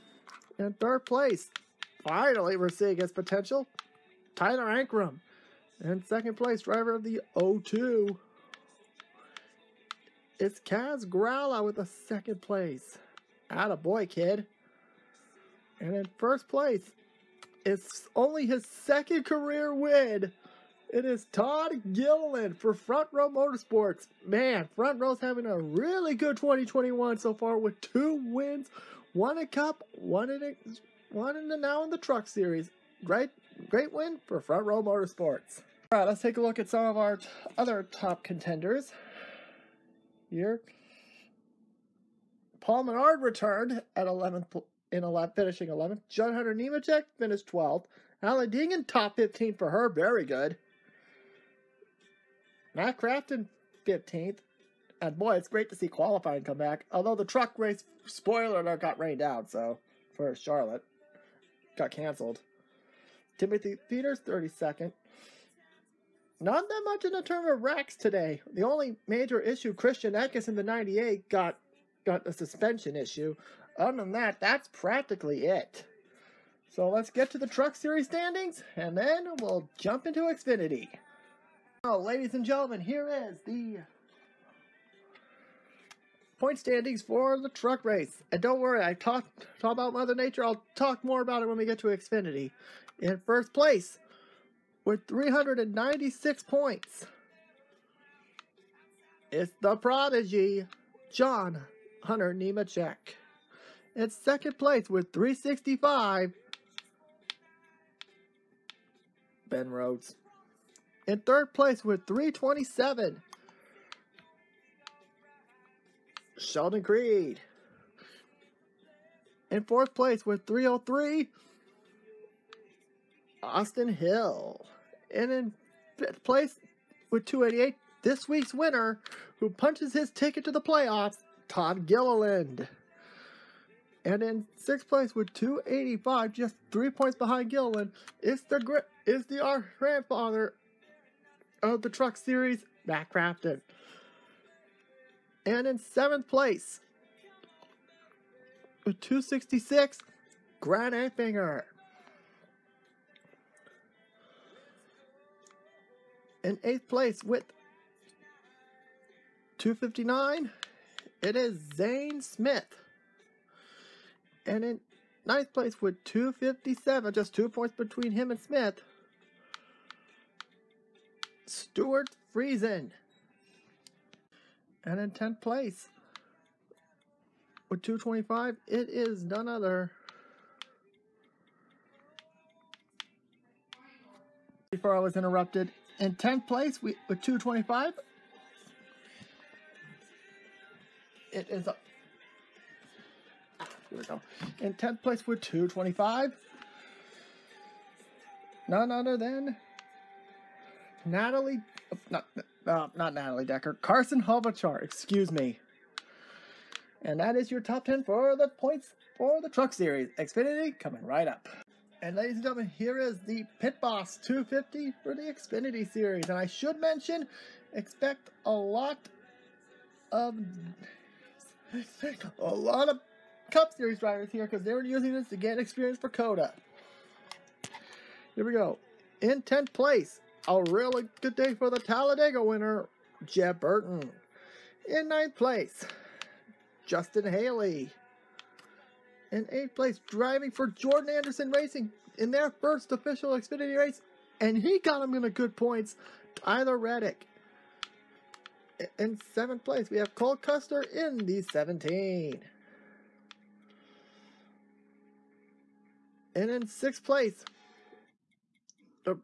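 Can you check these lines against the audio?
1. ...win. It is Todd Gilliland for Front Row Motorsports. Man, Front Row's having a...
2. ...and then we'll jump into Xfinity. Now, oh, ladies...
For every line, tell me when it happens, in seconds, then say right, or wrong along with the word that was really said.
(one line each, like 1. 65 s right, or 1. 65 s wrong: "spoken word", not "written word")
1. 19 s right
2. 78 s right.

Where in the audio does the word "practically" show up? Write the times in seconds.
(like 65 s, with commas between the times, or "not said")
74 s.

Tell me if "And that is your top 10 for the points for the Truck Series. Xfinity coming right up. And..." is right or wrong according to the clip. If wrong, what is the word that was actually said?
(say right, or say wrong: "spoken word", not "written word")
right.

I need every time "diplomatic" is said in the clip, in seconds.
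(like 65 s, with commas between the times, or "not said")
not said.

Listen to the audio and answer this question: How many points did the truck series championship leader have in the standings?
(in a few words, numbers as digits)
396.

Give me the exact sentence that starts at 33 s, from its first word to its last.
Great, great win for Front Row Motorsports.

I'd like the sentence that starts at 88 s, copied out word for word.
And don't worry, I talked talk about Mother Nature.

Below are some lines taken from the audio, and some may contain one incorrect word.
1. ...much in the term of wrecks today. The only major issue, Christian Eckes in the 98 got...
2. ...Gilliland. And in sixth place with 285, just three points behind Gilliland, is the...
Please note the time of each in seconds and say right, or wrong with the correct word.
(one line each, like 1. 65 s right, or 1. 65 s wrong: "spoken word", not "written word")
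1. 66 s right
2. 131 s right.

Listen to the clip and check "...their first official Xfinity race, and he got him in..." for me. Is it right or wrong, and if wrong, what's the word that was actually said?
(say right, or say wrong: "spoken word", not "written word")
right.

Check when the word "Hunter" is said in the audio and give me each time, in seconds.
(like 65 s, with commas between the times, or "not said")
46 s, 102 s.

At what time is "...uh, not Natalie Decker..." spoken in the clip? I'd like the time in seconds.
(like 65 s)
202 s.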